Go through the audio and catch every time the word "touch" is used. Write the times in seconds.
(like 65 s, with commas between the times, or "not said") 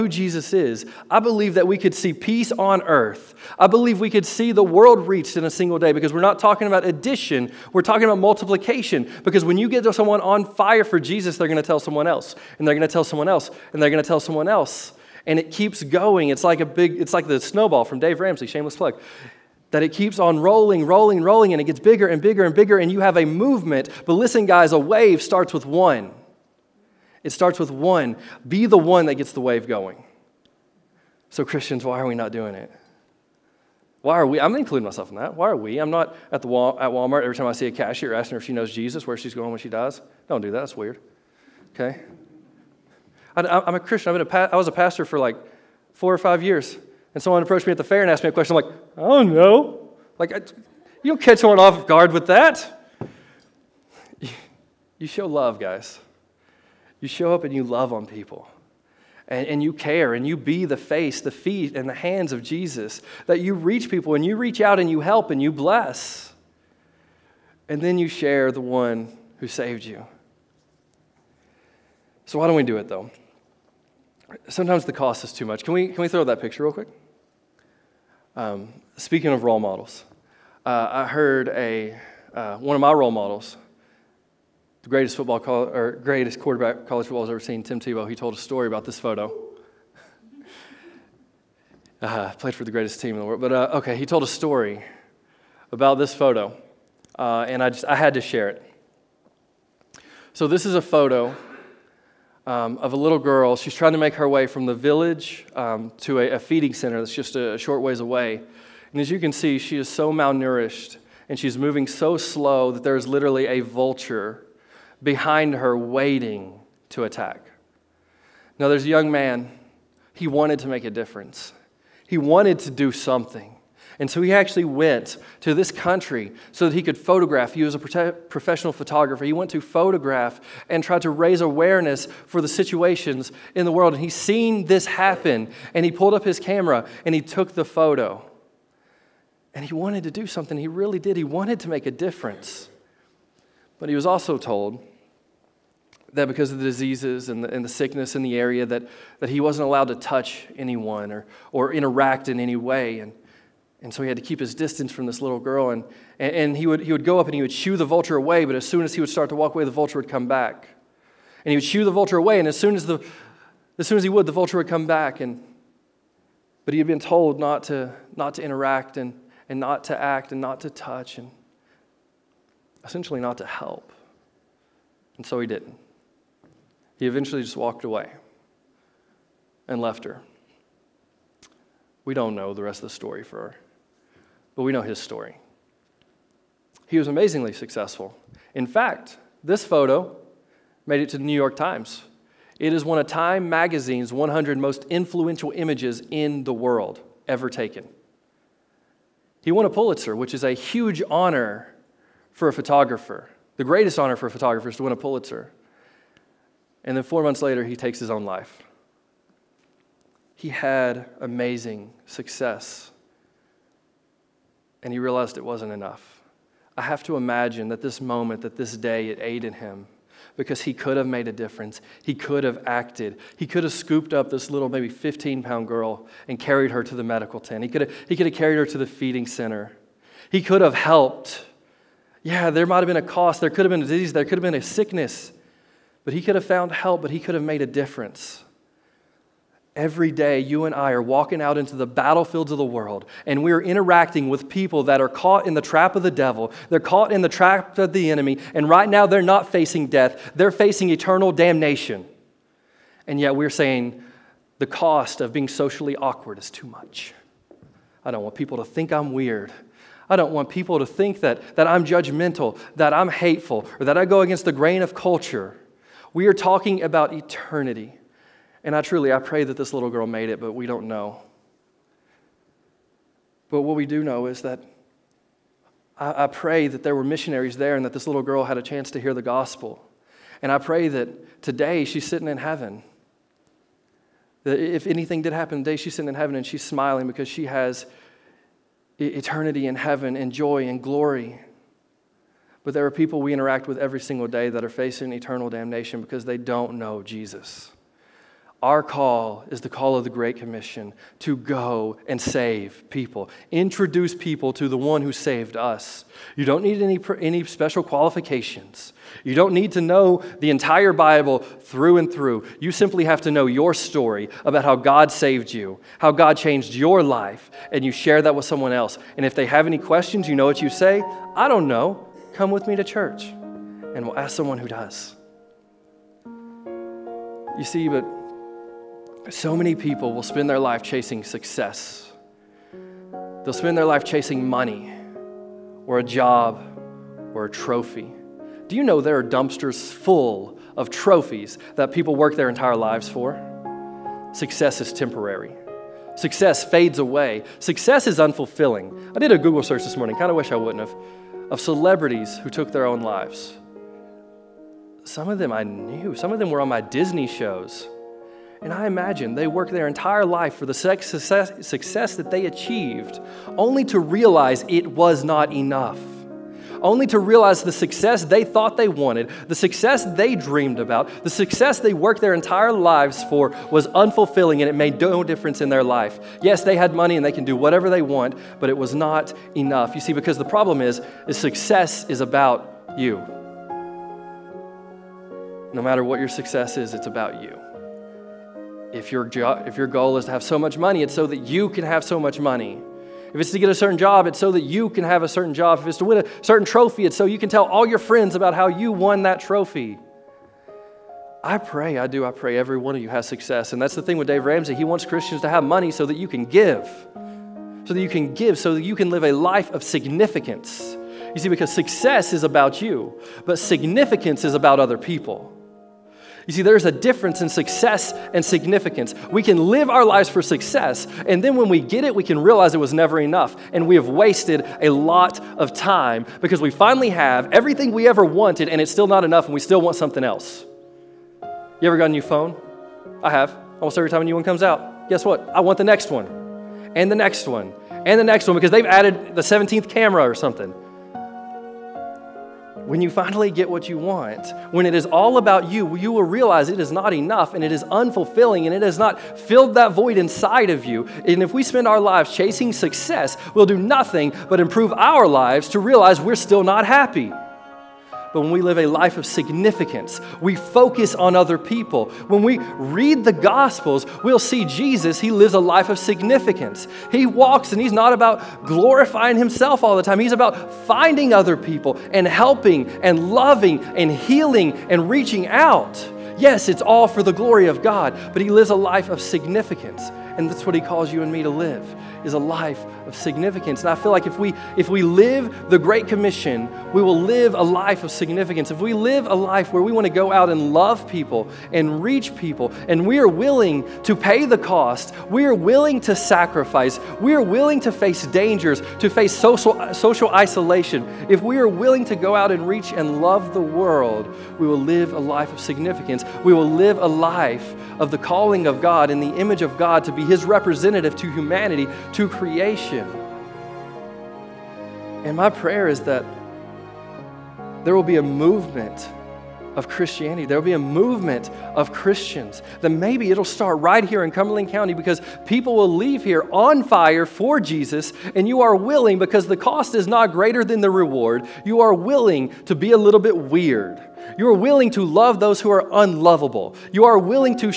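149 s, 170 s.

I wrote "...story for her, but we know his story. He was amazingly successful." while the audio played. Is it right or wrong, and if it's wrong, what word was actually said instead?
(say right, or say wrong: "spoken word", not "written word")
right.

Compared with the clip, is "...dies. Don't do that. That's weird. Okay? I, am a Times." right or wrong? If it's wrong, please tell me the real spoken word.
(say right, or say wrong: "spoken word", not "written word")
wrong: "Christian", not "Times".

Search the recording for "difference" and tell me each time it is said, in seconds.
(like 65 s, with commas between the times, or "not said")
120 s, 141 s, 221 s, 237 s, 375 s, 416 s.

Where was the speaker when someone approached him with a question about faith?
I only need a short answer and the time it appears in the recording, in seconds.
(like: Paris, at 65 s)
the fair, at 47 s.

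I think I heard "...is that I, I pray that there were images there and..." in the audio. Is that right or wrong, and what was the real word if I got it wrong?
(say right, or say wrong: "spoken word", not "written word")
wrong: "missionaries", not "images".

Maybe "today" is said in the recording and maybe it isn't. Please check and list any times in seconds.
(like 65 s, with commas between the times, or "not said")
281 s, 285 s.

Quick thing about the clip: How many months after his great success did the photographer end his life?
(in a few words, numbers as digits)
4.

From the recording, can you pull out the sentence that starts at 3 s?
I believe we could see the world reached in a single day because we're not talking about addition, we're talking about multiplication.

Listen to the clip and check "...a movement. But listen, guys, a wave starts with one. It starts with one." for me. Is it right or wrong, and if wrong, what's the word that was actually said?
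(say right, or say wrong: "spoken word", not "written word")
right.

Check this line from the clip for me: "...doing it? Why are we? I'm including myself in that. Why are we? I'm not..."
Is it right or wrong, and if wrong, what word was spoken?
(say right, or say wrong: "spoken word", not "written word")
right.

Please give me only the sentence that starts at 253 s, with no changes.
And yet, we're saying the cost of being socially awkward is too much.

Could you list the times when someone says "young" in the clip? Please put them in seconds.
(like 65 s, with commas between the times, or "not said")
118 s.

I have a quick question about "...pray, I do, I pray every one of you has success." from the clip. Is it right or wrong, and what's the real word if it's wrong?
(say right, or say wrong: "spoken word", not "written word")
right.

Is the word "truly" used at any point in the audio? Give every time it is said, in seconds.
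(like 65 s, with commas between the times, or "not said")
268 s.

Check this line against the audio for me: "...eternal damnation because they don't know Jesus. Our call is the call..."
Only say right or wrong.
right.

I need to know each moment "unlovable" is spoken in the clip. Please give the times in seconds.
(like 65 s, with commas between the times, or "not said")
535 s.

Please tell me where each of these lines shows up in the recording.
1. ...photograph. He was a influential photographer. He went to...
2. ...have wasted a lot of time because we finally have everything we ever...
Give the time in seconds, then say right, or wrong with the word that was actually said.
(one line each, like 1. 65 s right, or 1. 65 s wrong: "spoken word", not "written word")
1. 126 s wrong: "professional", not "influential"
2. 423 s right.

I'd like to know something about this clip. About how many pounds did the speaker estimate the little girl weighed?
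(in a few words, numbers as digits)
15.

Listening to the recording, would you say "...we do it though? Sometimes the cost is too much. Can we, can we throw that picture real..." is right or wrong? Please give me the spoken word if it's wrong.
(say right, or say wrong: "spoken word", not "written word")
right.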